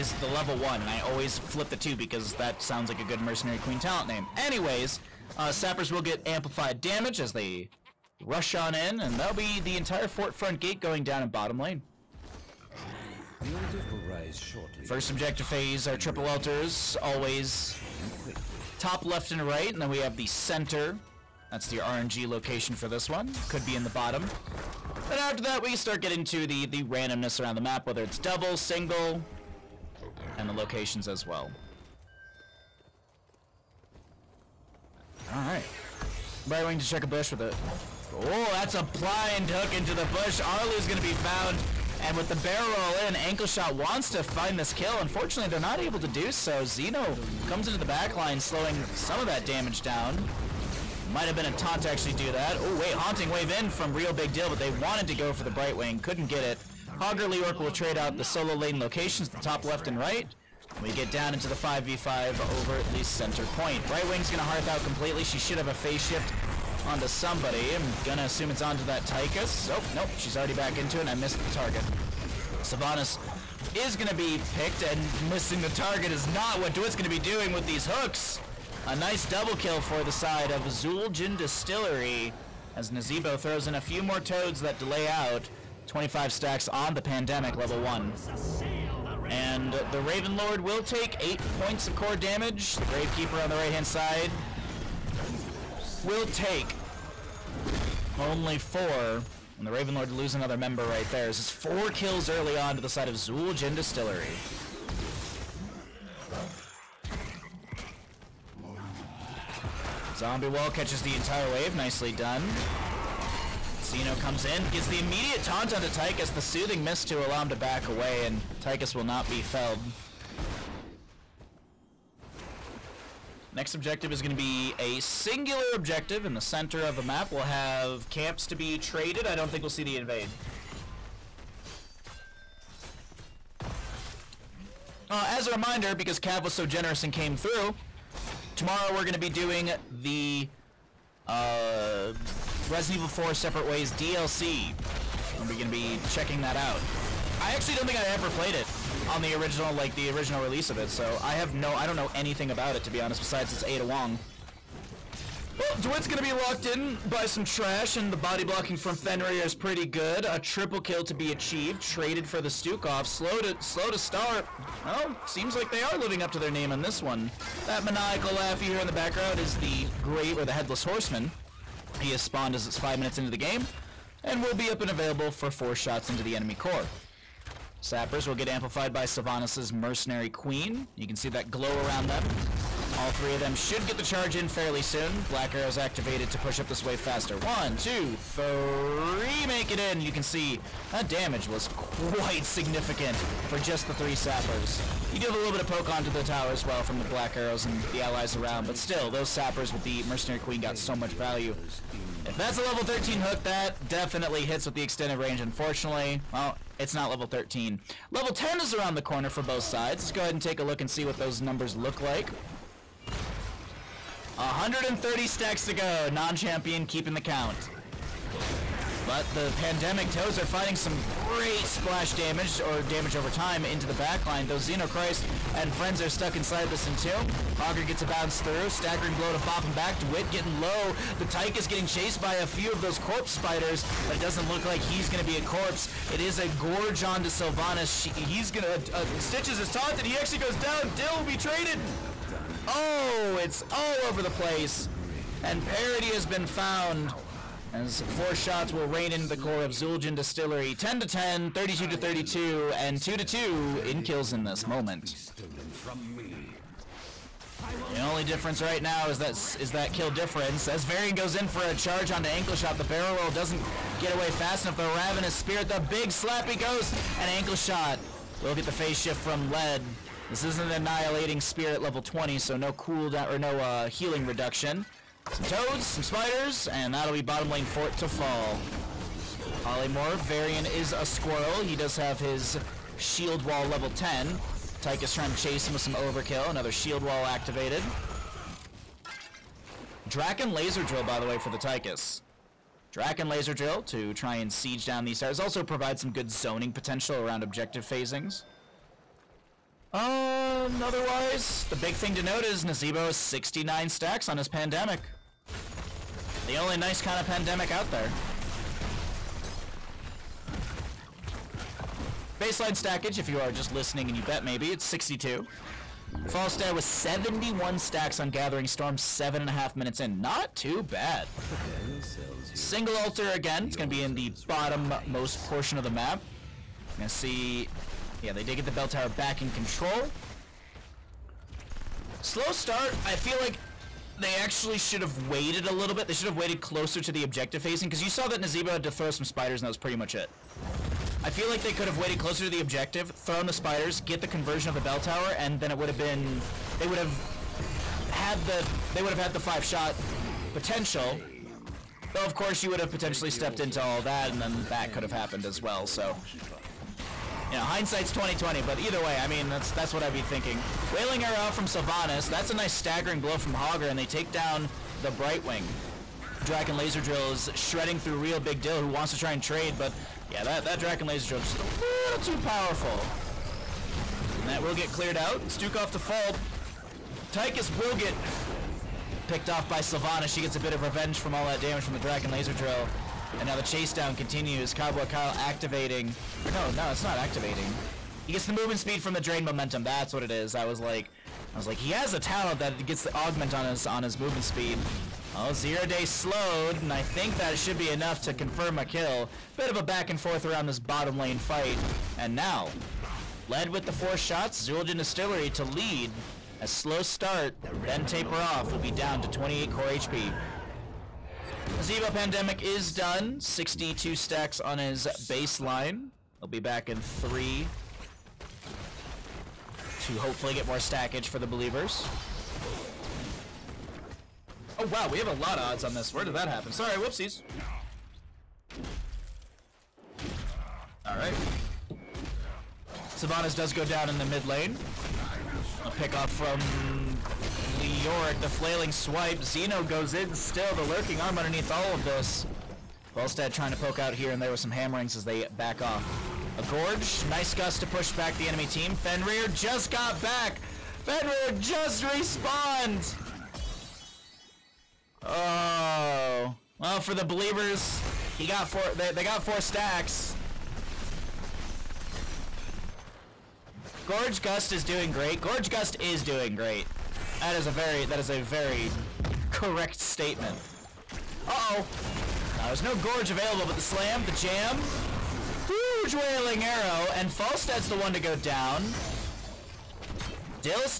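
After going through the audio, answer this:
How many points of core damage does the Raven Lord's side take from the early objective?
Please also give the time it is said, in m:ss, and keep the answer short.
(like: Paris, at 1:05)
8, at 1:31.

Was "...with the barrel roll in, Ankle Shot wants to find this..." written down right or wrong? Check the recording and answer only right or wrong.
right.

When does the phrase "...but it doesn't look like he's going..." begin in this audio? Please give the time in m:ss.
3:54.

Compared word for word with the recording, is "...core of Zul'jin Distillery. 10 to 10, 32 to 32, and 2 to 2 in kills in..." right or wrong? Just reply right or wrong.
right.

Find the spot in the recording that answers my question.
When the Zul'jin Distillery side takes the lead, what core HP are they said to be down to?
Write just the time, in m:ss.
6:49.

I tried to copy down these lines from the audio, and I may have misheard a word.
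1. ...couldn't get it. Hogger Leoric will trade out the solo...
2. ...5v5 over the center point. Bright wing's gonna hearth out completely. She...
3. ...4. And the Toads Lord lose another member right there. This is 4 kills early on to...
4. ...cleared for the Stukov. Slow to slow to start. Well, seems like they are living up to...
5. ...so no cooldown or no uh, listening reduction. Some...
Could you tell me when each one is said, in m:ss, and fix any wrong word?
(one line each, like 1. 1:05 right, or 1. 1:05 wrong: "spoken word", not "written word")
1. 0:55 right
2. 1:01 right
3. 1:38 wrong: "Raven", not "Toads"
4. 2:41 wrong: "traded", not "cleared"
5. 4:32 wrong: "healing", not "listening".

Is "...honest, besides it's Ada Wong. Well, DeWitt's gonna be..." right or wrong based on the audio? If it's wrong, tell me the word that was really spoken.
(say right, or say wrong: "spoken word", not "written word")
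right.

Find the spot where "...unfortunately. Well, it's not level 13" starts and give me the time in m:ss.
3:25.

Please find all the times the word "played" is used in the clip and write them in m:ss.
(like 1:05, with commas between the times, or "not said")
2:28.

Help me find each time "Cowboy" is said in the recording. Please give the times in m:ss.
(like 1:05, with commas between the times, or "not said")
6:24.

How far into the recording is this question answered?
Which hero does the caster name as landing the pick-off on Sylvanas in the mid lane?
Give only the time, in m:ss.
7:17.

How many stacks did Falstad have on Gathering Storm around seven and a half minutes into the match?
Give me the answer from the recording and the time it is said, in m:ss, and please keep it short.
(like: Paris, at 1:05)
71, at 5:16.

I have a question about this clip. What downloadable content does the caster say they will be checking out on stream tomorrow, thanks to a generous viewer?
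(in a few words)
Resident Evil 4 Separate Ways.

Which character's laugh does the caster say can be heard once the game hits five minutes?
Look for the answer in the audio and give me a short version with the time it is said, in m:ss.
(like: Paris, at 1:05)
Headless Horseman, at 2:50.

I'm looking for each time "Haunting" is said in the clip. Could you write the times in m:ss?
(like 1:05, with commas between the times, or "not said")
0:52.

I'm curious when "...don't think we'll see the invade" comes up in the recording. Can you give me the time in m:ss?
2:09.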